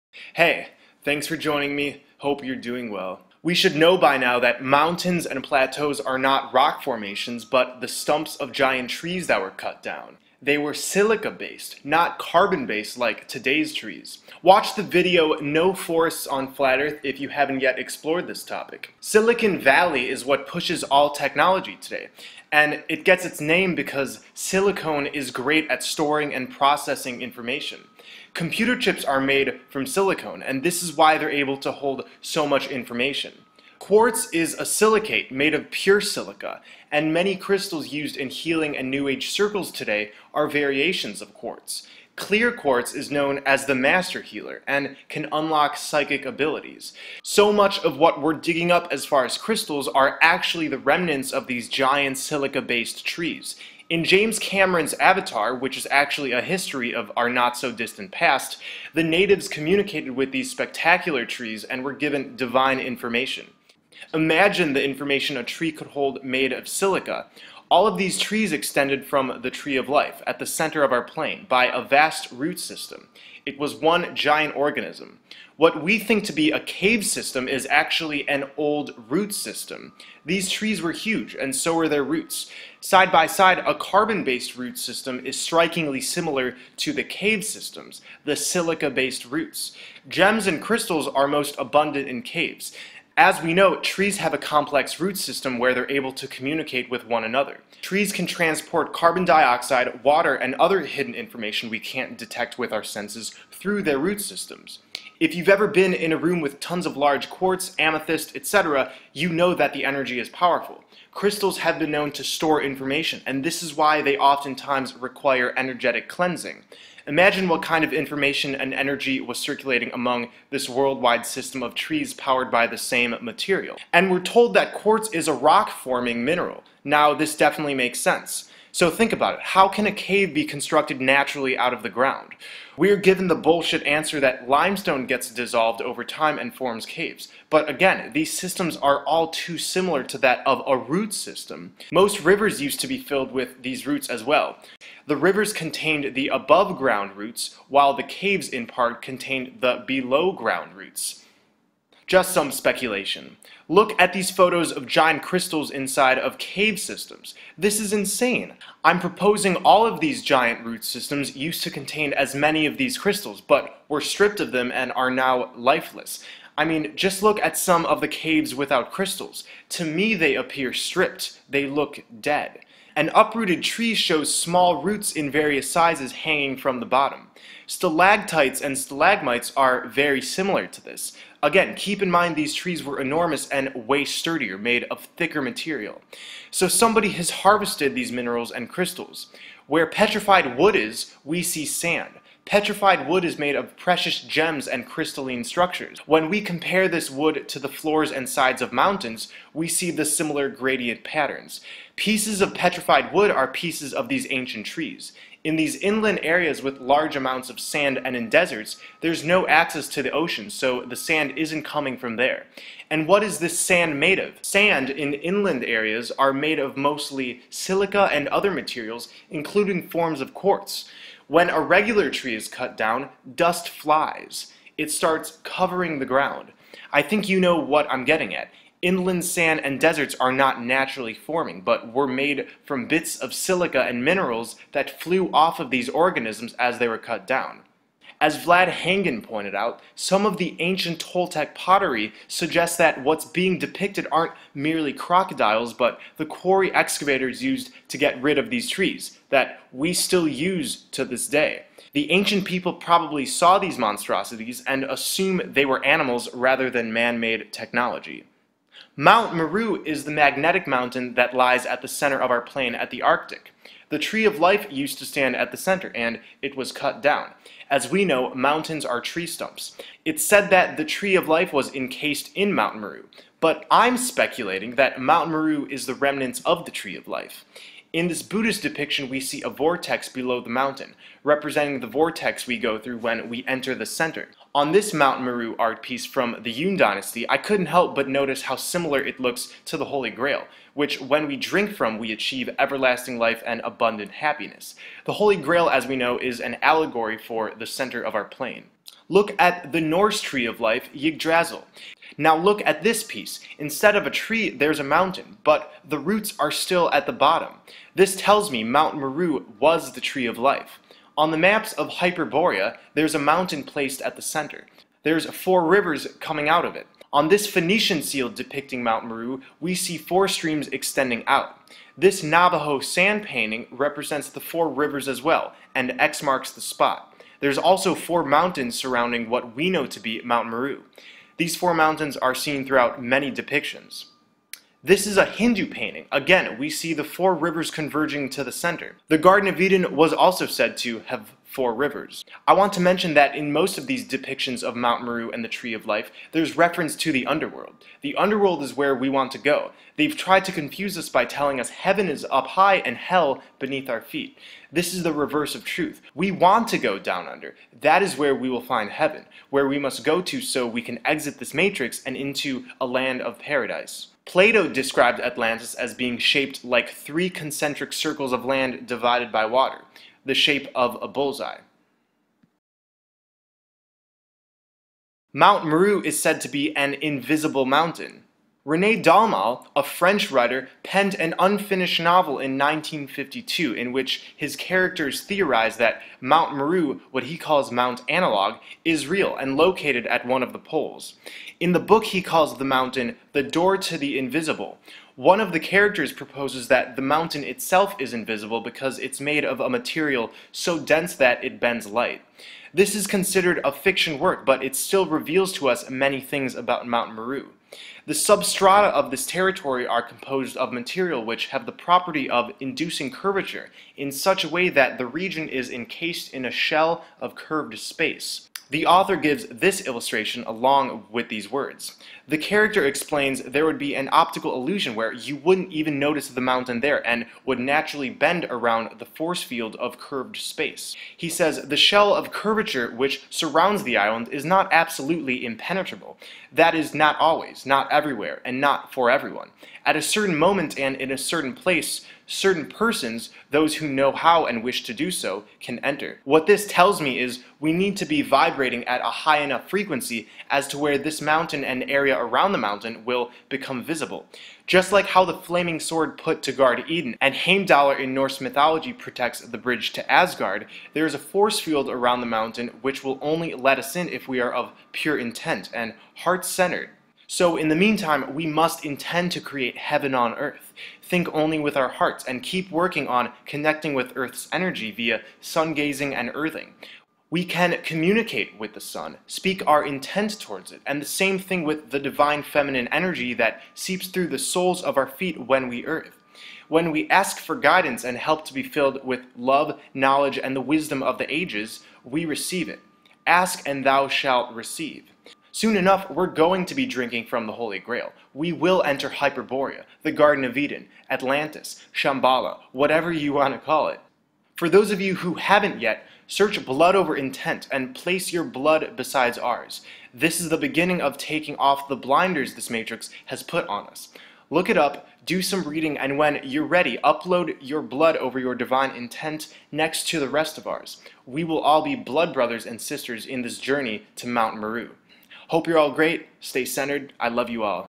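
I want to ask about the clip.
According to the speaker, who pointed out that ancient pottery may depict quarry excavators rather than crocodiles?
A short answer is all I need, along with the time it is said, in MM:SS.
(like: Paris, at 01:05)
Vlad Hangen, at 03:58.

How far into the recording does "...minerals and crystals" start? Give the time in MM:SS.
03:08.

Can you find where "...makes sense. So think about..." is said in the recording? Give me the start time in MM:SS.
02:07.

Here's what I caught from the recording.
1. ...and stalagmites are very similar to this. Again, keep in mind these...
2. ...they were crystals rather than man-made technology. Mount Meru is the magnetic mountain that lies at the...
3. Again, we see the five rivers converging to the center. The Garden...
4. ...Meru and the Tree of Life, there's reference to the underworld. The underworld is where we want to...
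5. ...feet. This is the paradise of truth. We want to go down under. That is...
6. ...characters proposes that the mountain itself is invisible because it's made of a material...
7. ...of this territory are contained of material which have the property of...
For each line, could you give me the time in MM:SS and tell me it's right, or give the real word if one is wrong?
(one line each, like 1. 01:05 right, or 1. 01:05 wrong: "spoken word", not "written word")
1. 02:58 right
2. 04:15 wrong: "animals", not "crystals"
3. 05:36 wrong: "four", not "five"
4. 05:45 right
5. 05:53 wrong: "reverse", not "paradise"
6. 06:35 right
7. 06:48 wrong: "composed", not "contained".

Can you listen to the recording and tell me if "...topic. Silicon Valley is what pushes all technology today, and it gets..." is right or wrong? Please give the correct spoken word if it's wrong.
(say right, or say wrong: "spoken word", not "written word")
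right.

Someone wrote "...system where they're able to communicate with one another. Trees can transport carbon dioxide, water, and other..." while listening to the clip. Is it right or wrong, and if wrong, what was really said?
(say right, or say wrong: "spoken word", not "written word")
right.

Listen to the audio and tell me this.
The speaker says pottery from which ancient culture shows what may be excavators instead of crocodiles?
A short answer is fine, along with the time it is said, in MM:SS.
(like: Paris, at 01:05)
Toltec, at 04:00.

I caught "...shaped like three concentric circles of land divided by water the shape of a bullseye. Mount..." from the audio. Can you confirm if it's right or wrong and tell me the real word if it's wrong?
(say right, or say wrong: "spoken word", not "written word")
right.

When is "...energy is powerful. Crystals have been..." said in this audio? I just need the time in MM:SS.
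01:49.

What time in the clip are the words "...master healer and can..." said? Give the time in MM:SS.
00:43.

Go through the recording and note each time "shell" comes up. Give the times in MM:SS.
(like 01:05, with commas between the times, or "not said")
06:56, 07:11.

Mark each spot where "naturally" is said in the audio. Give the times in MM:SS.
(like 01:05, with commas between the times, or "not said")
02:11, 03:50, 07:07.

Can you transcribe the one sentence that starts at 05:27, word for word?
There's also four mountains surrounding what we know to be Mount Meru.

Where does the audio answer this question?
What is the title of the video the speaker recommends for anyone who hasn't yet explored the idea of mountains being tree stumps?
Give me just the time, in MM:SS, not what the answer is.
00:15.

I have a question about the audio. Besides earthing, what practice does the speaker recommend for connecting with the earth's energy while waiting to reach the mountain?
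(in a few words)
Sun gazing.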